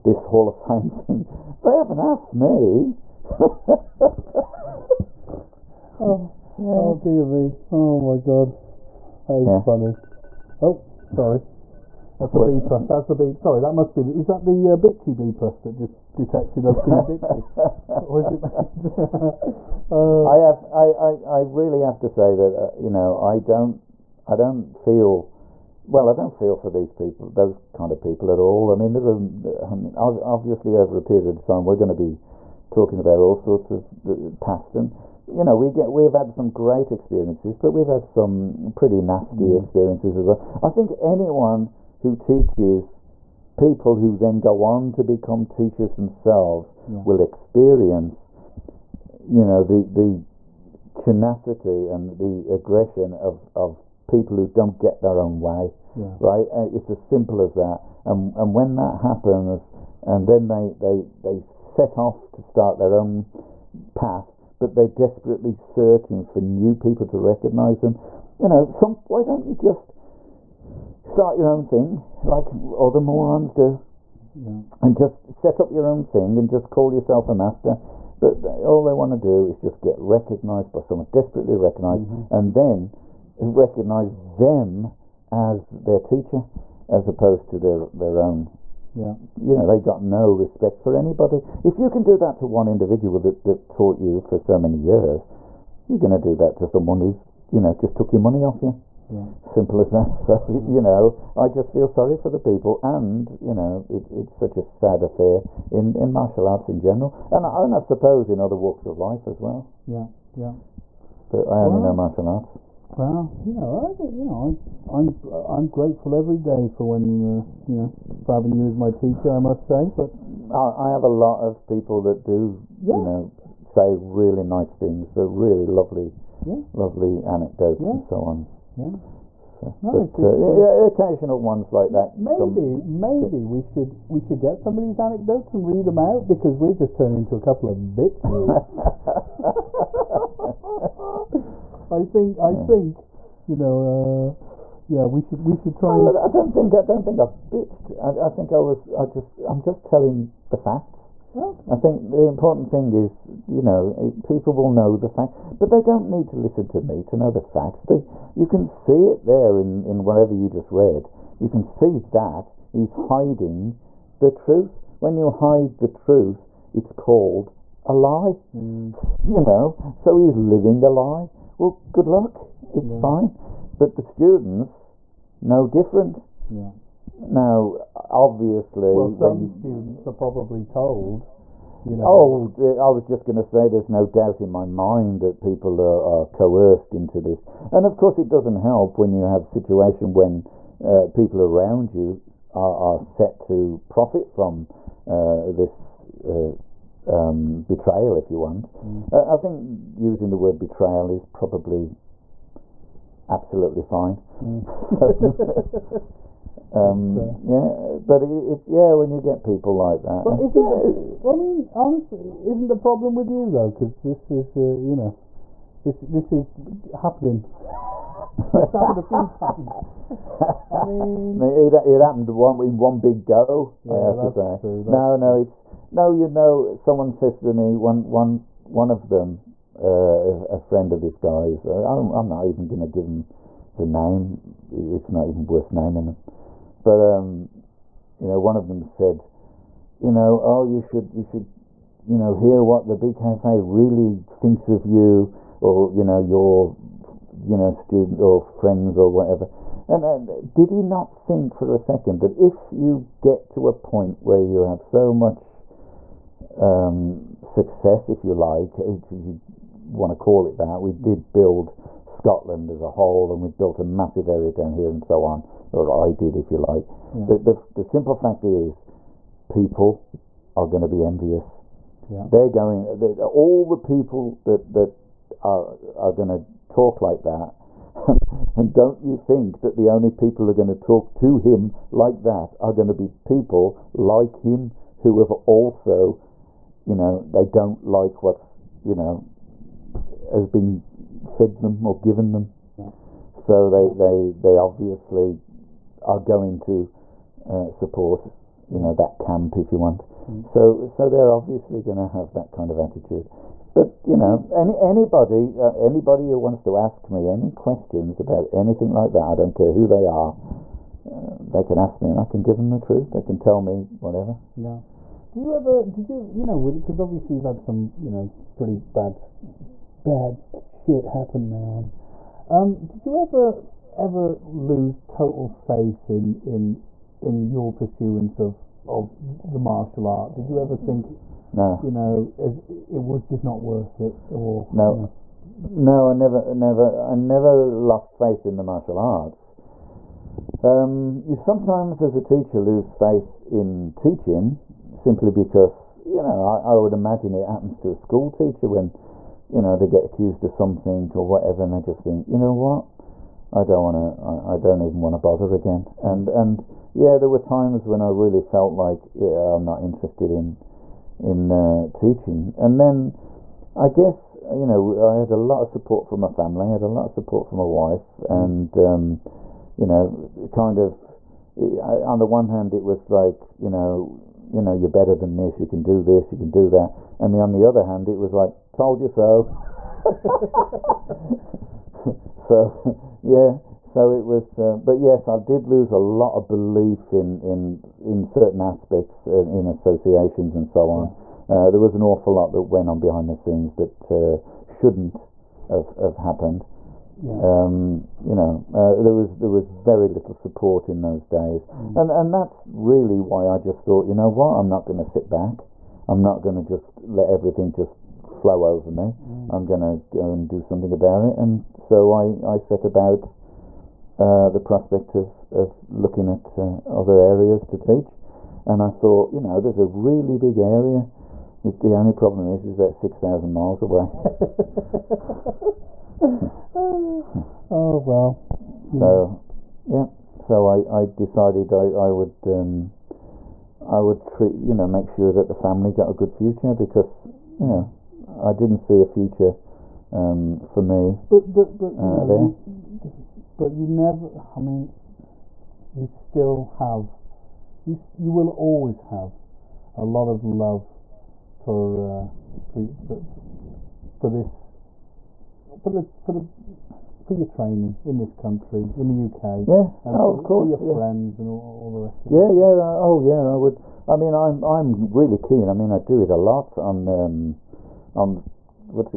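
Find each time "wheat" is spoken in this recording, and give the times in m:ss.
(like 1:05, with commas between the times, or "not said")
not said.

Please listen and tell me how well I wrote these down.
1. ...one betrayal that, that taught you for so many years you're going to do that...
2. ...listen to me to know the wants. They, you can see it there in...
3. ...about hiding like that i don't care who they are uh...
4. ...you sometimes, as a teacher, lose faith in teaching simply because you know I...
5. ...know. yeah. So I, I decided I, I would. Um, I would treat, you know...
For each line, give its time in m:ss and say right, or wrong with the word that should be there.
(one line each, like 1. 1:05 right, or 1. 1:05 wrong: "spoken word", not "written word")
1. 1:32 wrong: "individual", not "betrayal"
2. 2:36 wrong: "facts", not "wants"
3. 5:08 wrong: "anything", not "hiding"
4. 5:41 right
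5. 7:09 right.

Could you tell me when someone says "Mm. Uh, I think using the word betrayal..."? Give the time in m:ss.
3:18.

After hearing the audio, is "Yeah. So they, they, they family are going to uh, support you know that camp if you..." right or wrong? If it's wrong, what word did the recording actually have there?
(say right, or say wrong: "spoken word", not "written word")
wrong: "obviously", not "family".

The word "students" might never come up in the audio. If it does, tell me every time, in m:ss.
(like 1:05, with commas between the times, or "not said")
2:54, 2:59, 4:07.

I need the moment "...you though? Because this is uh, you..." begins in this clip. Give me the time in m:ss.
3:33.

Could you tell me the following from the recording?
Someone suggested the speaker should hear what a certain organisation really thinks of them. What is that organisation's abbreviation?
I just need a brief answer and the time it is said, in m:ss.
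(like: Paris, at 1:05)
BKFA, at 4:02.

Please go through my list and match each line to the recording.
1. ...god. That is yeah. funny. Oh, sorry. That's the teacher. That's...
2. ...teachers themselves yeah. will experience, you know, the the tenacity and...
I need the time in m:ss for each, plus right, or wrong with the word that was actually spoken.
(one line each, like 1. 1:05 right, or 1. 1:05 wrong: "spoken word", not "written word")
1. 0:08 wrong: "beeper", not "teacher"
2. 0:45 right.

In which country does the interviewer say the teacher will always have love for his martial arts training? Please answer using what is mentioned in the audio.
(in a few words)
UK.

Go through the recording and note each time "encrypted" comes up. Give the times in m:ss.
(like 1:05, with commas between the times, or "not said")
not said.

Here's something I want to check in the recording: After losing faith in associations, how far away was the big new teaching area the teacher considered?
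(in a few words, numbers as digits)
6,000 miles.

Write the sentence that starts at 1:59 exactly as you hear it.
I must say, but I, I have a lot of people that do yeah.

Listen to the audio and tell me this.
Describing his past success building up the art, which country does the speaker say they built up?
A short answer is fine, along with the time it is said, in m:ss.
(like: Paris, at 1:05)
Scotland, at 4:22.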